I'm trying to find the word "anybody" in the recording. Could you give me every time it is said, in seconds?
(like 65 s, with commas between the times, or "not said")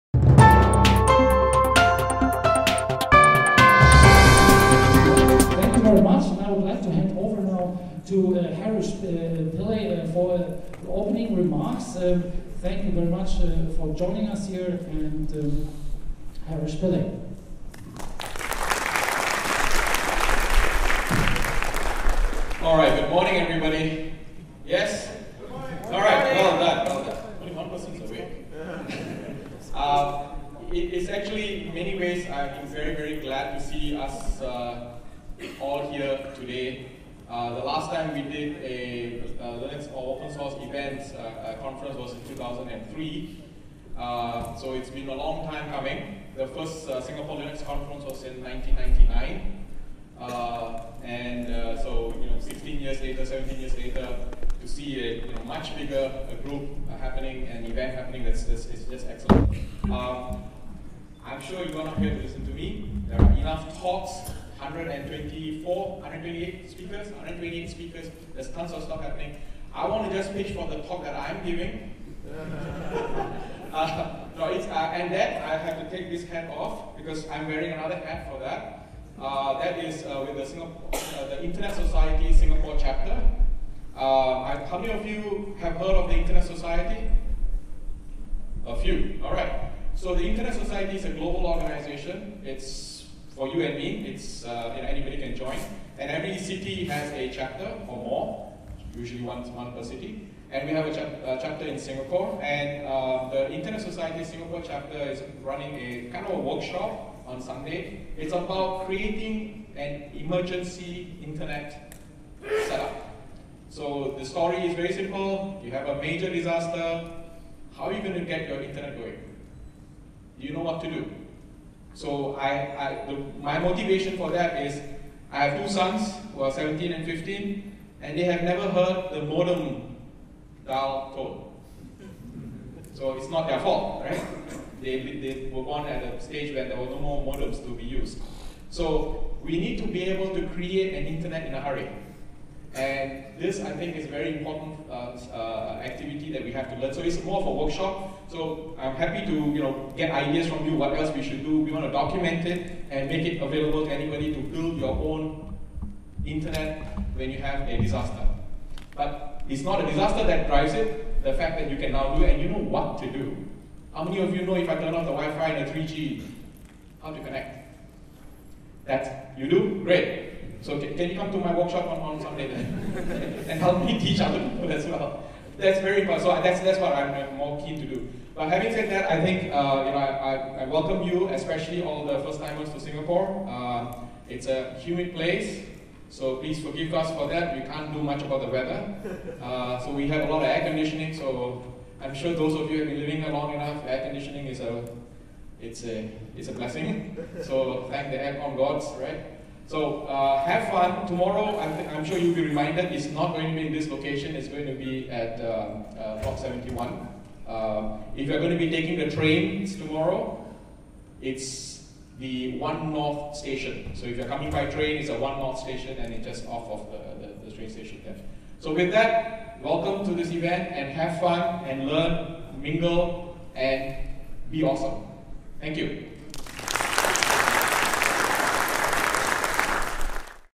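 94 s, 153 s.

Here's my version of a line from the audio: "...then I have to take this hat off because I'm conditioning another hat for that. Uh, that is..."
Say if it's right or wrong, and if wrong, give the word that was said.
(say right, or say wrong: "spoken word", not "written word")
wrong: "wearing", not "conditioning".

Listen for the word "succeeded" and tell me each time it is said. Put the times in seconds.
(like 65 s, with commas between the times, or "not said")
not said.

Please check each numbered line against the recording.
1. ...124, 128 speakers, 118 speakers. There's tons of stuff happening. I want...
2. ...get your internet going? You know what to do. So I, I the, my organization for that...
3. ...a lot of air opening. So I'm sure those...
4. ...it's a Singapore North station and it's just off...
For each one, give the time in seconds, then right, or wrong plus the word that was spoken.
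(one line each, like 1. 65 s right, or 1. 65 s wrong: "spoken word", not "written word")
1. 64 s wrong: "128", not "118"
2. 118 s wrong: "motivation", not "organization"
3. 190 s wrong: "conditioning", not "opening"
4. 214 s wrong: "One", not "Singapore".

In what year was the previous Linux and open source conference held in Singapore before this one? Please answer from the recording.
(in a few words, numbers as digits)
2003.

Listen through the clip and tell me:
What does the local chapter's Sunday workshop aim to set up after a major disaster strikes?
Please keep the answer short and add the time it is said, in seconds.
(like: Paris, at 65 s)
An emergency internet setup, at 110 s.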